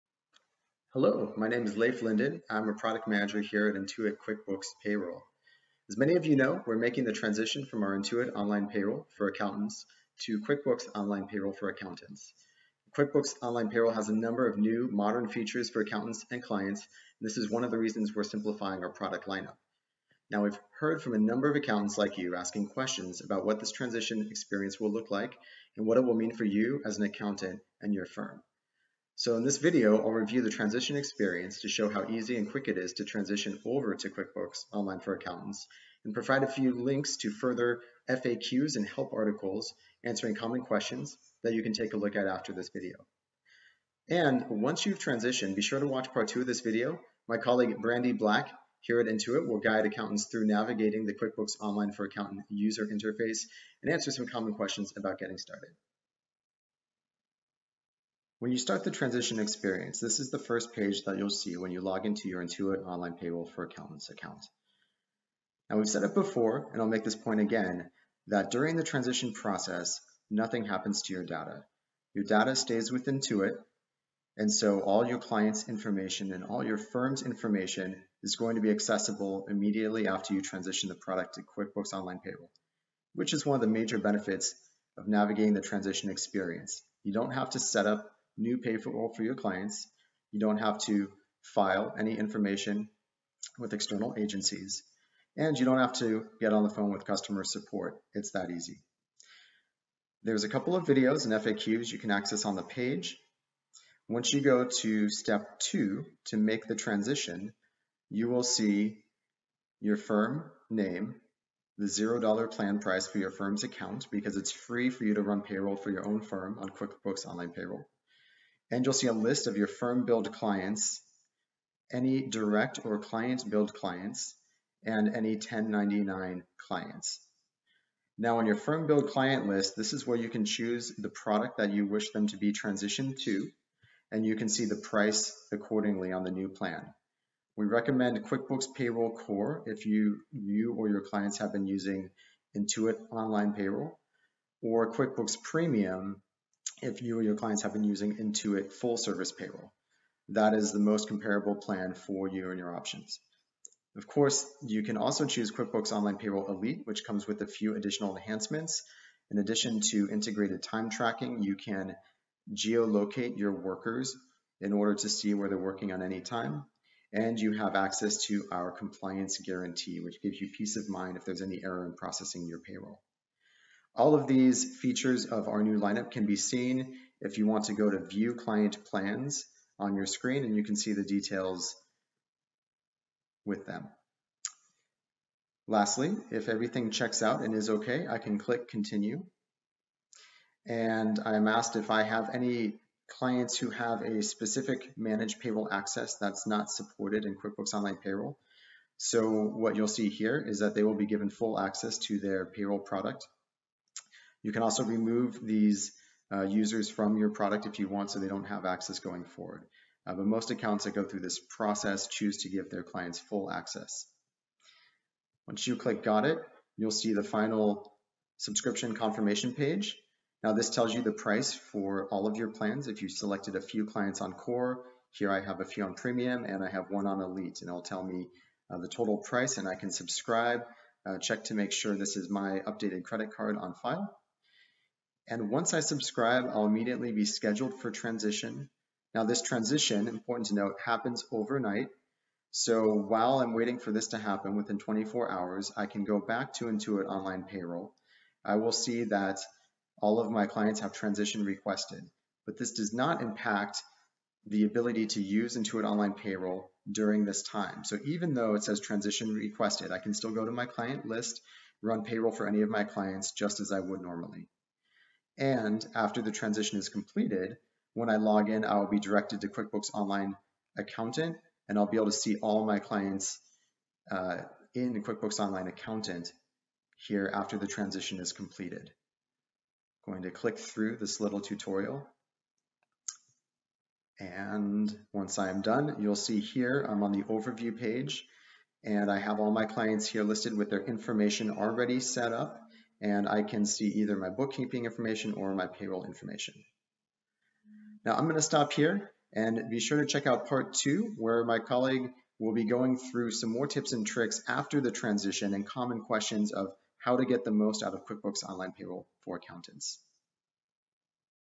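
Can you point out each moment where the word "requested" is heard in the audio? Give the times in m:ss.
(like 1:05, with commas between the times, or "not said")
4:11, 4:19.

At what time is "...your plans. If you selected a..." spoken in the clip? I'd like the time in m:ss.
3:42.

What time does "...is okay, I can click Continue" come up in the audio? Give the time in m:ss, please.
3:07.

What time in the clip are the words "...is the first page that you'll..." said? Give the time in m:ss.
1:00.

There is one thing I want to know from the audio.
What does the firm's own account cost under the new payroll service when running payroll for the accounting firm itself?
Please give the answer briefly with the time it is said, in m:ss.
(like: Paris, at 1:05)
$0, at 1:51.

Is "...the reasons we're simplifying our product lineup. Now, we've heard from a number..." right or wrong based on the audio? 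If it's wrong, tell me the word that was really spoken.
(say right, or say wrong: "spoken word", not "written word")
right.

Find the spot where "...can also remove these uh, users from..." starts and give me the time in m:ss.
3:24.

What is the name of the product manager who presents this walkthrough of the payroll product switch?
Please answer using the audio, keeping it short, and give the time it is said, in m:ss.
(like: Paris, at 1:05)
Leif Linden, at 0:01.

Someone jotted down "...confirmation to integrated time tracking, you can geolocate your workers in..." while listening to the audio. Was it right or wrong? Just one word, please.
wrong.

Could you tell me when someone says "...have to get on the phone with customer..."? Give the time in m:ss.
1:35.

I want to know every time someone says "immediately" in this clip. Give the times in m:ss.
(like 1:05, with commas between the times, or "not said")
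1:19, 3:56.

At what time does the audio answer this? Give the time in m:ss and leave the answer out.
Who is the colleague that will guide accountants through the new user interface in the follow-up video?
0:47.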